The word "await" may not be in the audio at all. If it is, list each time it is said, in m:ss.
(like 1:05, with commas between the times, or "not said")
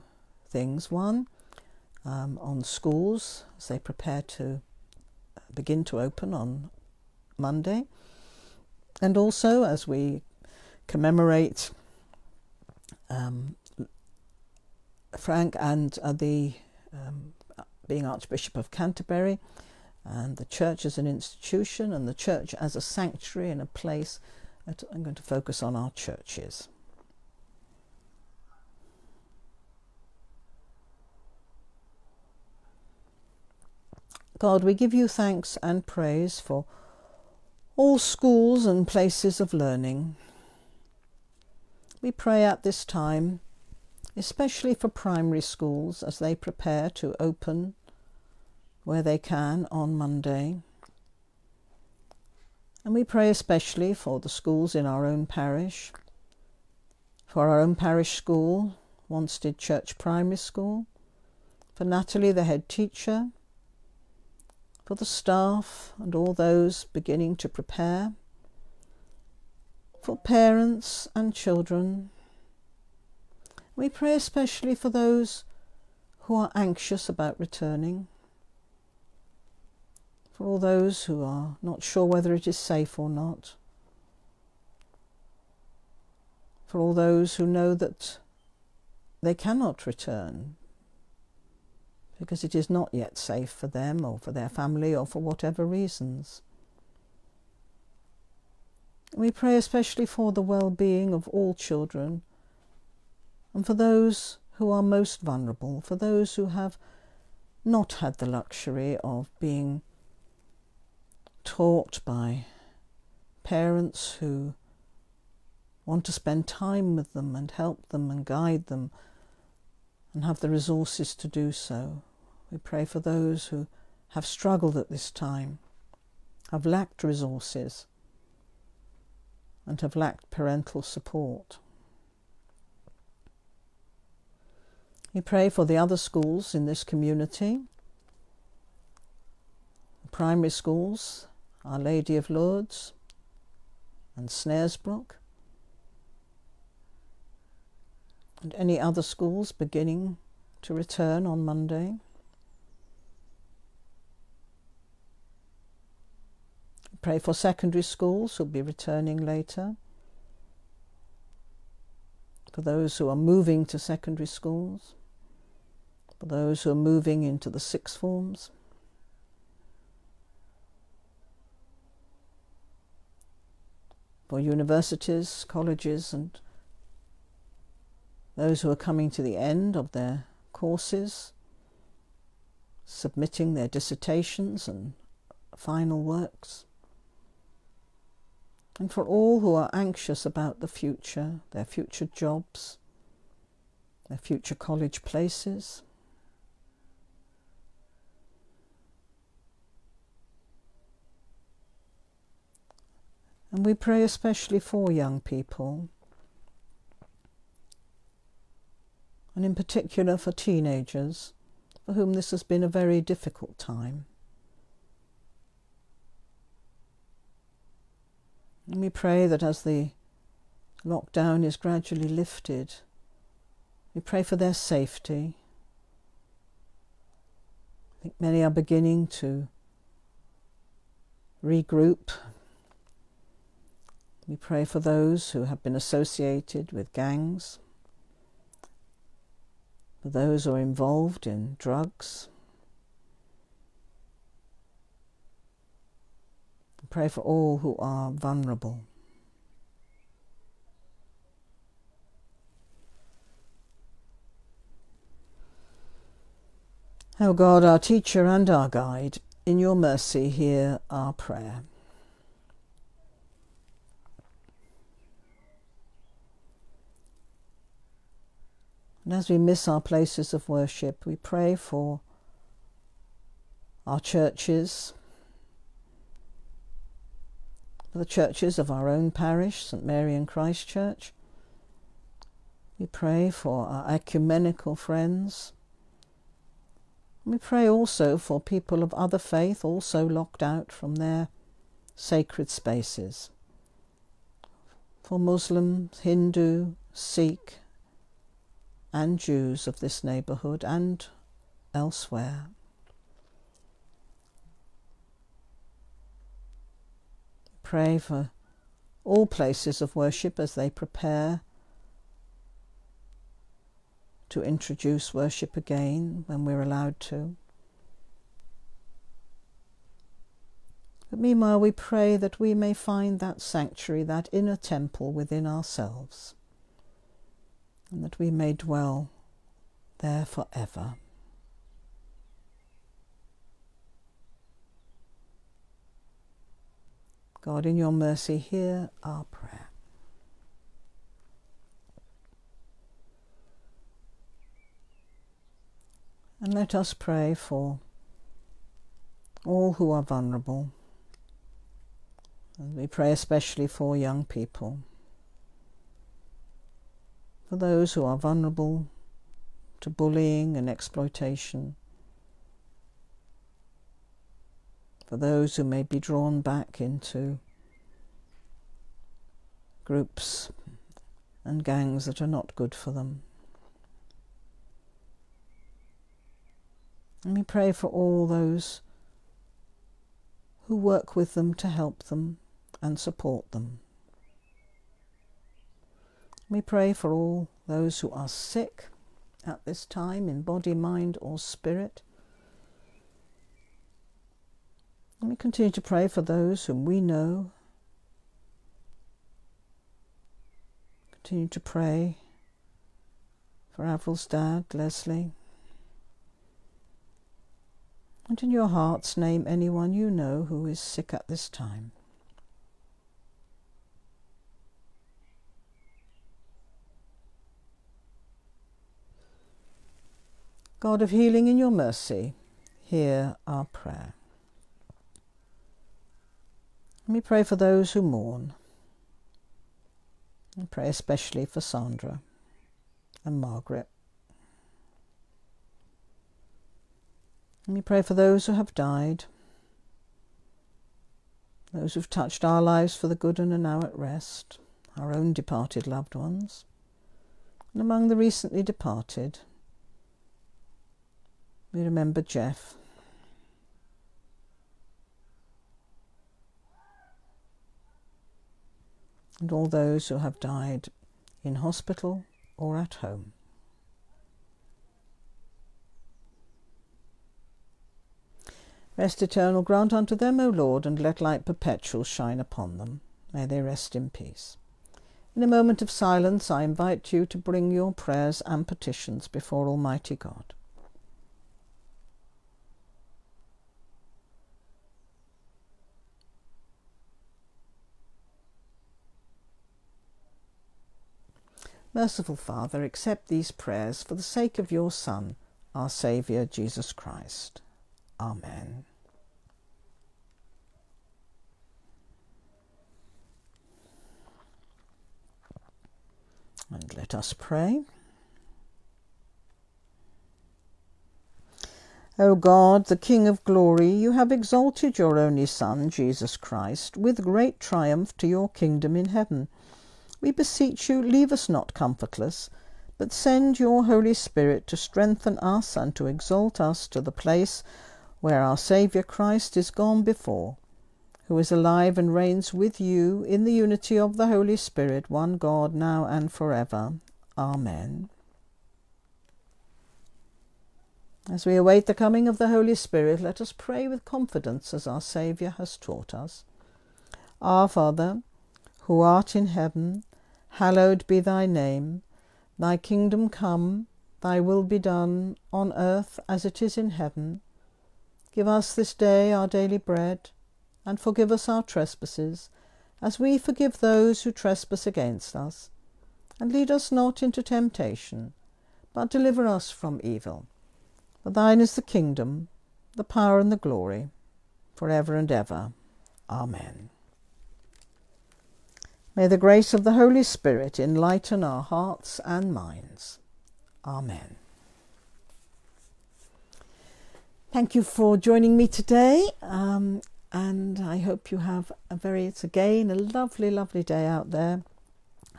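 9:01.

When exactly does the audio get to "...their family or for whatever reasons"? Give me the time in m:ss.
1:34.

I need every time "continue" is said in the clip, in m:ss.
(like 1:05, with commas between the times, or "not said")
6:35, 6:41.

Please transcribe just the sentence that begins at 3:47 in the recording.
I think many are beginning to regroup.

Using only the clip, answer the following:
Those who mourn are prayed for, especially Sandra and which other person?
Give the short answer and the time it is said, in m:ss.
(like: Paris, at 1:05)
Margaret, at 7:13.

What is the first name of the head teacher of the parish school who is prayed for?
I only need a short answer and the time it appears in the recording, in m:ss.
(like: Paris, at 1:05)
Natalie, at 1:01.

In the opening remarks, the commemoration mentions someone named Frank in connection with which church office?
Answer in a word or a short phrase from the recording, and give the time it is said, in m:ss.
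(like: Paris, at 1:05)
Archbishop of Canterbury, at 0:18.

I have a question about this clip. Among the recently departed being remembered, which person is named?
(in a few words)
Jeff.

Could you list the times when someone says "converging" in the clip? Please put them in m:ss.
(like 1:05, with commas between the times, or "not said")
not said.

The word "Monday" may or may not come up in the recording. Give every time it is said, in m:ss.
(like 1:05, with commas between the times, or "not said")
0:07, 0:49, 2:31.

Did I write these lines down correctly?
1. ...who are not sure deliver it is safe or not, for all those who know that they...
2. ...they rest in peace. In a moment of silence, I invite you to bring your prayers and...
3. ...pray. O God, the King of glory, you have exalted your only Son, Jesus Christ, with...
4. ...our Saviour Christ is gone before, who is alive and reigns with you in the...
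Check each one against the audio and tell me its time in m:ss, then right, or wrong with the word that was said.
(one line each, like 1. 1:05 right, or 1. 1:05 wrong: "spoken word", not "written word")
1. 1:21 wrong: "whether", not "deliver"
2. 7:53 right
3. 8:27 right
4. 8:48 right.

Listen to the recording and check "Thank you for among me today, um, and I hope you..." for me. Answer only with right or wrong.
wrong.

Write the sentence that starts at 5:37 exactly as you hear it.
God, in your mercy, hear our prayer.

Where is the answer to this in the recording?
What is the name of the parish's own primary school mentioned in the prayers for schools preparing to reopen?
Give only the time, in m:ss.
0:59.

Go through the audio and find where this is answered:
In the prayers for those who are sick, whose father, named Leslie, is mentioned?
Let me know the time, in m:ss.
6:43.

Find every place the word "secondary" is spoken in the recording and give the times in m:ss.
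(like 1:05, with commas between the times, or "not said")
2:37, 2:43.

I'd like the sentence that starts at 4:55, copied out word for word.
For Muslims, Hindu, Sikh, and Jews of this neighbourhood and elsewhere.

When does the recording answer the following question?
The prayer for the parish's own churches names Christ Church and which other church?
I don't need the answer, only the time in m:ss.
4:39.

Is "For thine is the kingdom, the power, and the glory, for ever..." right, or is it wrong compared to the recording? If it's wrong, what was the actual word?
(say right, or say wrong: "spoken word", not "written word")
right.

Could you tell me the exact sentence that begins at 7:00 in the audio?
God of healing in your mercy, hear our prayer.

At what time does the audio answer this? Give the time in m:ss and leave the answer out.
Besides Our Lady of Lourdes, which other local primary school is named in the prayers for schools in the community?
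2:24.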